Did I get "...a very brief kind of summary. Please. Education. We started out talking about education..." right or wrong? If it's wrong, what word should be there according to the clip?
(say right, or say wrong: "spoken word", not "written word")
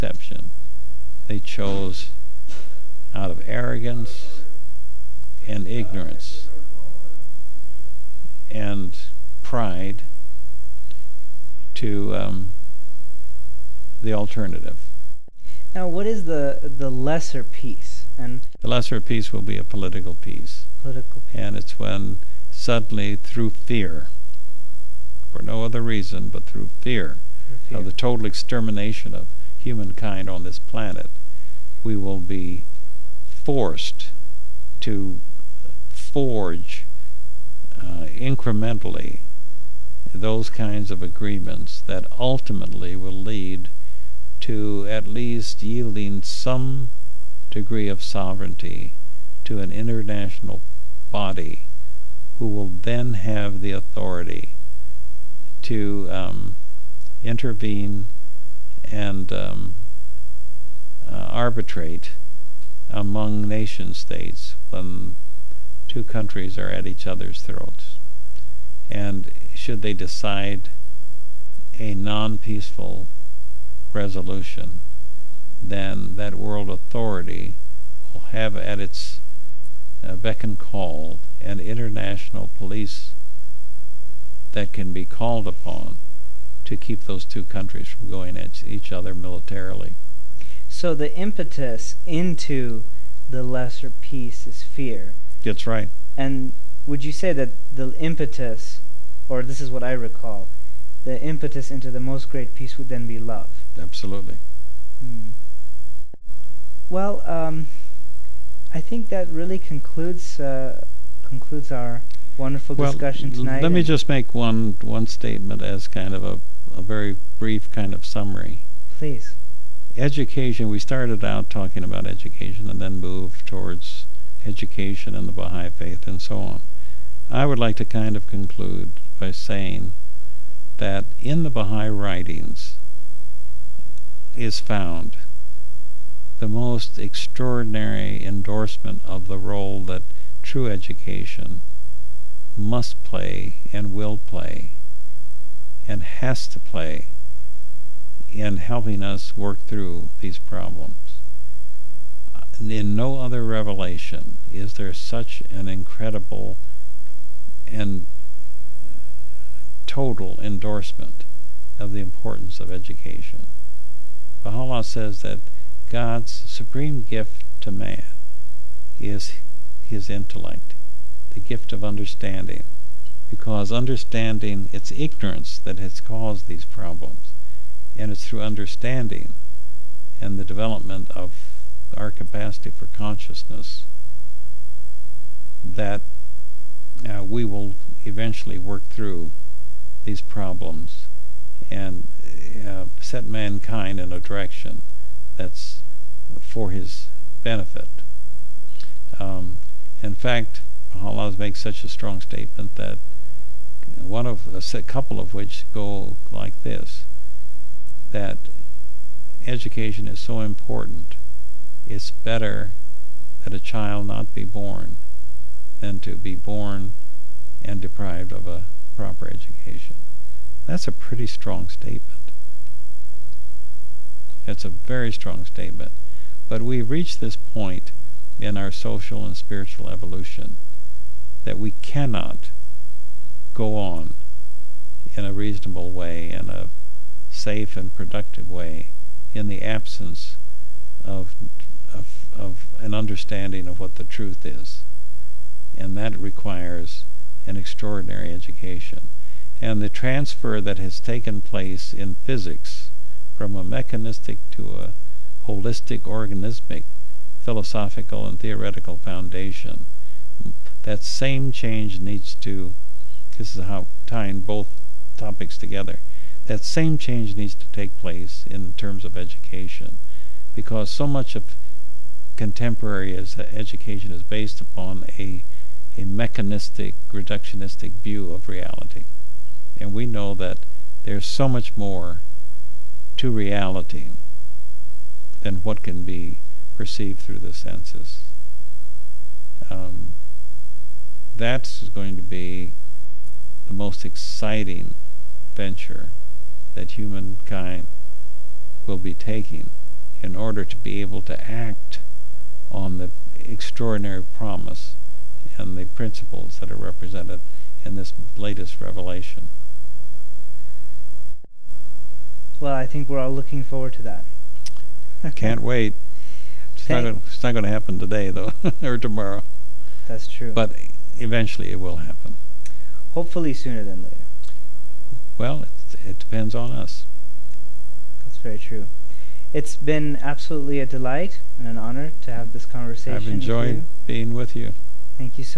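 right.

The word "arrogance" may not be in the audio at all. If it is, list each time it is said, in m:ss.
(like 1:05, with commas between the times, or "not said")
0:03.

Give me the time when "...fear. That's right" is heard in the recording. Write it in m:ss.
1:34.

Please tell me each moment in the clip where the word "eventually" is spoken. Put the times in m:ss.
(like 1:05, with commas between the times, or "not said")
3:08, 5:21.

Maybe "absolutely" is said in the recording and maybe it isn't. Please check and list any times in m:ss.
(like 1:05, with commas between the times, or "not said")
1:43, 5:30.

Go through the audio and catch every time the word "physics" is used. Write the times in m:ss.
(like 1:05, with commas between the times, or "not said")
4:12.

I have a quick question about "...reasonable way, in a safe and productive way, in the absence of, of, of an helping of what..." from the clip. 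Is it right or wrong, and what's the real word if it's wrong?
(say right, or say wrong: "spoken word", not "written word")
wrong: "understanding", not "helping".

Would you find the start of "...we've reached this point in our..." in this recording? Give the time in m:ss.
3:46.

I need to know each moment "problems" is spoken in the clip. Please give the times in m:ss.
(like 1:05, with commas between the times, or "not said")
2:30, 2:56, 3:10.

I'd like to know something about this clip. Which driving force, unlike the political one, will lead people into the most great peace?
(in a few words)
Love.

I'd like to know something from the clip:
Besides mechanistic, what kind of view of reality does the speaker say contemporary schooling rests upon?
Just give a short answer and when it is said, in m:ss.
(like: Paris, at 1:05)
Reductionistic, at 4:37.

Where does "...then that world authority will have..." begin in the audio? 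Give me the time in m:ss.
1:15.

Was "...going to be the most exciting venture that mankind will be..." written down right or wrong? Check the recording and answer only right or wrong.
wrong.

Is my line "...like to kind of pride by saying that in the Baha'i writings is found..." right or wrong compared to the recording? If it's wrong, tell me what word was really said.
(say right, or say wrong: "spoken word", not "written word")
wrong: "conclude", not "pride".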